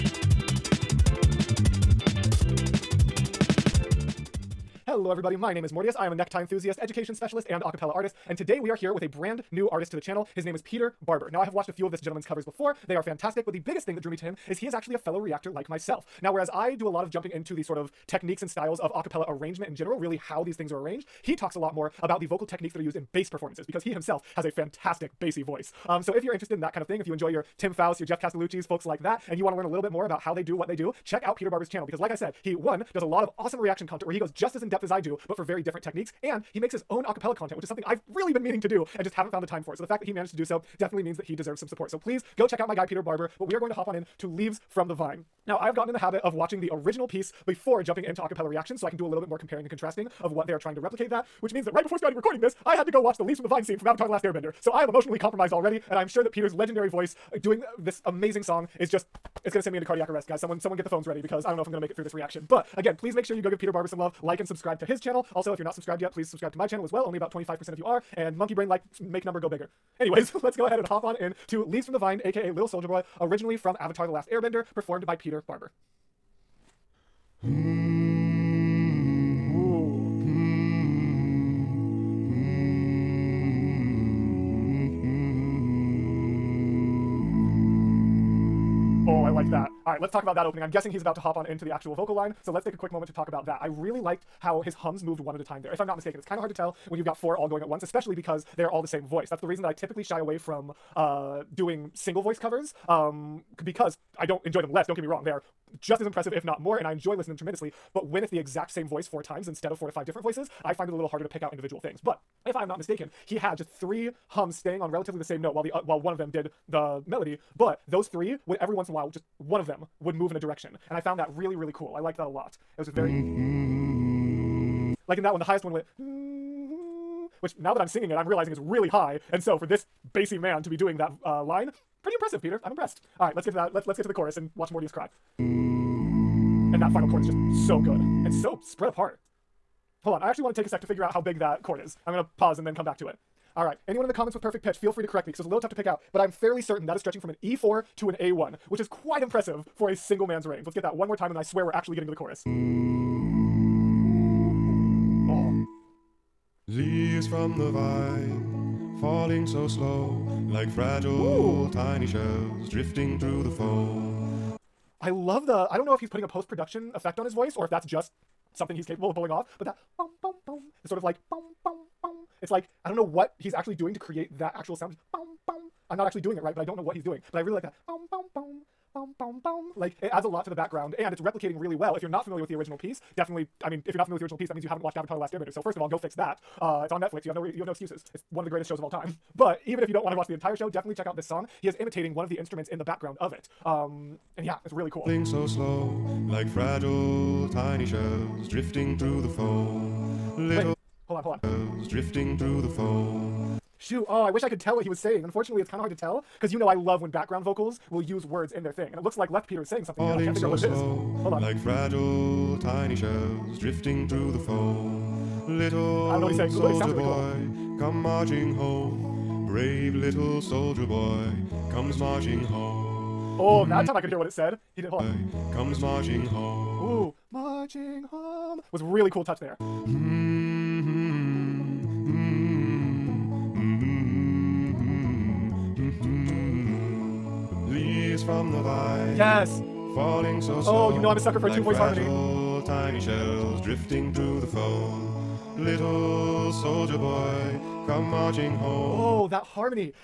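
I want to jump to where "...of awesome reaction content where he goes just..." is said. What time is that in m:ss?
0:33.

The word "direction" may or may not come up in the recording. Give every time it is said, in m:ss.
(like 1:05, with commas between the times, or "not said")
2:00.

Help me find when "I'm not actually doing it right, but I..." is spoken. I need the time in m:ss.
2:55.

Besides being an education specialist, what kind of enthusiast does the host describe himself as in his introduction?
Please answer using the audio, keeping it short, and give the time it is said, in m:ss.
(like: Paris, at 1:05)
necktie enthusiast, at 0:06.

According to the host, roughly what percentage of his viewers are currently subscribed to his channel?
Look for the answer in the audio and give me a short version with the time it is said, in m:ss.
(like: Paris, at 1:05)
25%, at 1:07.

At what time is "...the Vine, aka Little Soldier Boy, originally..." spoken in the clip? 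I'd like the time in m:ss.
1:11.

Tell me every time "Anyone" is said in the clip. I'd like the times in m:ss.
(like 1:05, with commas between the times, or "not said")
2:23.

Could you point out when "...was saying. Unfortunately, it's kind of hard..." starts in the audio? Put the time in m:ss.
3:24.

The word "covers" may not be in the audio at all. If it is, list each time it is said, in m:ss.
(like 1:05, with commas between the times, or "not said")
0:12, 1:42.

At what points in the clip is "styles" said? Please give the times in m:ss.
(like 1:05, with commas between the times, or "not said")
0:18.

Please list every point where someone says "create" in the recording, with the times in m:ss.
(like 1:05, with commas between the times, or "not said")
2:53.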